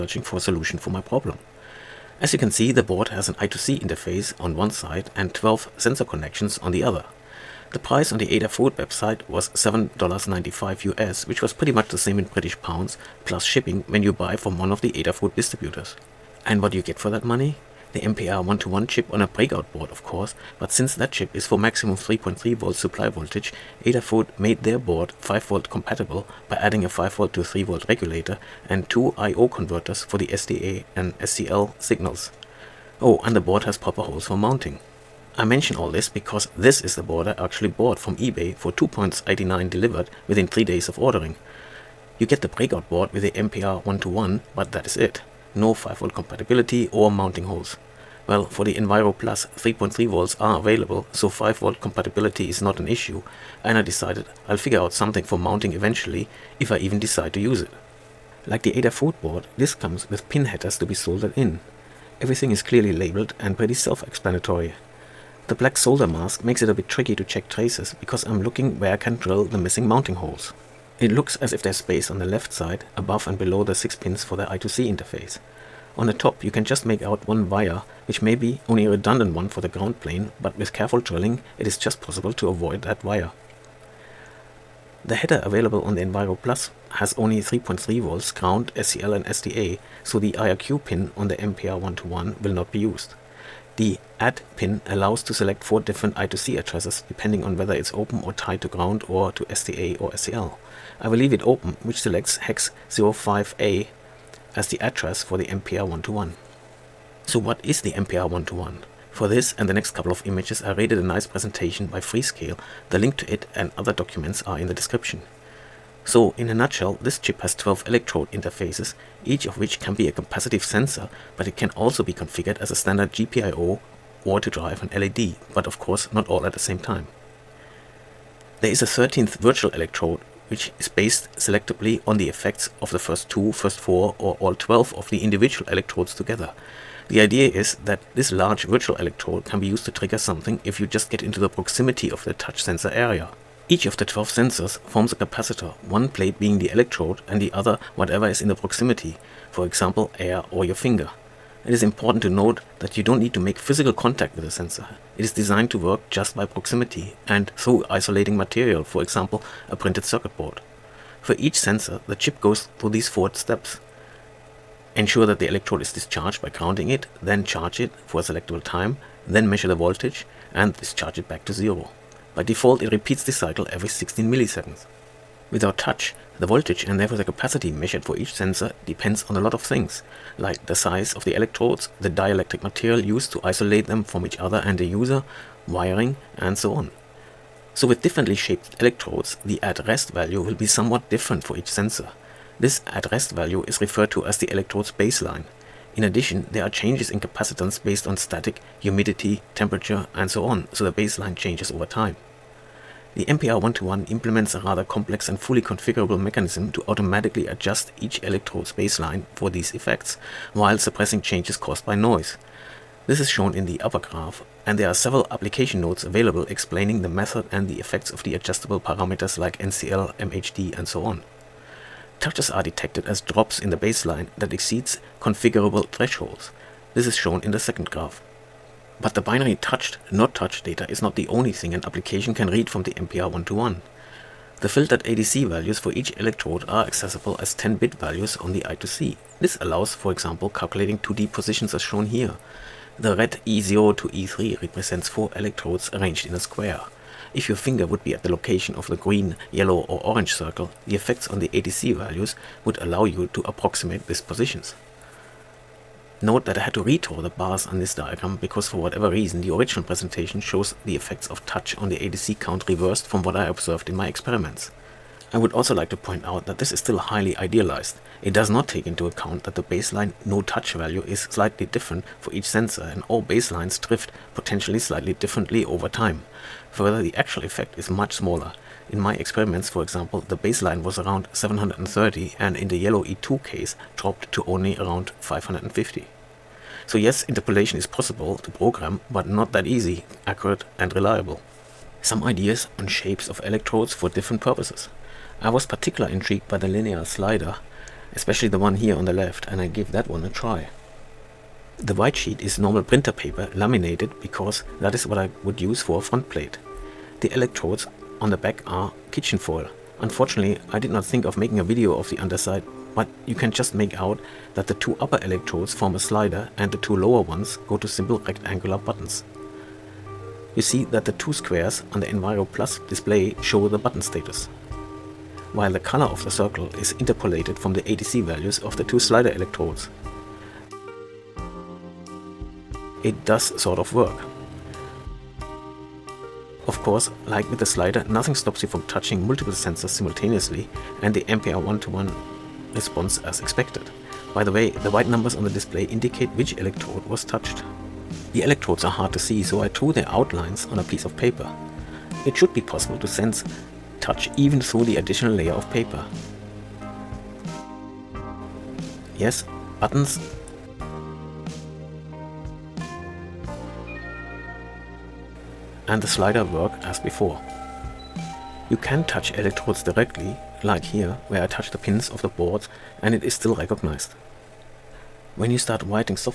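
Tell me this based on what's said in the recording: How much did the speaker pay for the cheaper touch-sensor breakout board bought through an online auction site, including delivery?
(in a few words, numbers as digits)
2.89.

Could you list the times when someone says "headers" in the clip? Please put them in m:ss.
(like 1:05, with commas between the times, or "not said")
1:00, 1:25.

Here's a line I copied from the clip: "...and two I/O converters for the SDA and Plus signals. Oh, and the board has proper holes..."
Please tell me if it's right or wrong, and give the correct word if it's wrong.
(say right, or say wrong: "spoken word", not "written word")
wrong: "SCL", not "Plus".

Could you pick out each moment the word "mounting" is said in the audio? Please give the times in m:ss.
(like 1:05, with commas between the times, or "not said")
0:34, 0:47, 0:55, 1:09.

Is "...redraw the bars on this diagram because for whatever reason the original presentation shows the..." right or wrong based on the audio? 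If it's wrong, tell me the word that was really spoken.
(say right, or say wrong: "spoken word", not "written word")
right.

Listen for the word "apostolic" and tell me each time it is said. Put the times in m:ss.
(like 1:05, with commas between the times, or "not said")
not said.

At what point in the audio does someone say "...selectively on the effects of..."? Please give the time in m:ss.
2:11.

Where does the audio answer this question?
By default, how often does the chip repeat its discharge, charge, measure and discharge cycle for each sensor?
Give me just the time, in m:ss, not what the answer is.
2:53.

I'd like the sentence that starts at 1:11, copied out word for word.
It looks as if there's space on the left side, above and below the 6 pins for the I2C interface.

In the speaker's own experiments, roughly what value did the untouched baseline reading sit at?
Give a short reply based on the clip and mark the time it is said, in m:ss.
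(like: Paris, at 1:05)
730, at 4:41.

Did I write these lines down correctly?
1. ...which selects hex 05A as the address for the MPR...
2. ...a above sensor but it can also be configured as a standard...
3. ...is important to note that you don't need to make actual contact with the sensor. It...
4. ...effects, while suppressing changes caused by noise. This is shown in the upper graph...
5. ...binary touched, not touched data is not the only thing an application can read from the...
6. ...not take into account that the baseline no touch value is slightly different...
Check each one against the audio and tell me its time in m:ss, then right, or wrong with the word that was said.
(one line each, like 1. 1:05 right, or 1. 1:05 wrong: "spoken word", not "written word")
1. 1:41 right
2. 2:00 wrong: "capacitive", not "above"
3. 2:31 wrong: "physical", not "actual"
4. 3:29 right
5. 3:49 right
6. 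4:28 right.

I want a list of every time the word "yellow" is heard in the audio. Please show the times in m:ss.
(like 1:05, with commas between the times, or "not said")
4:09, 4:42.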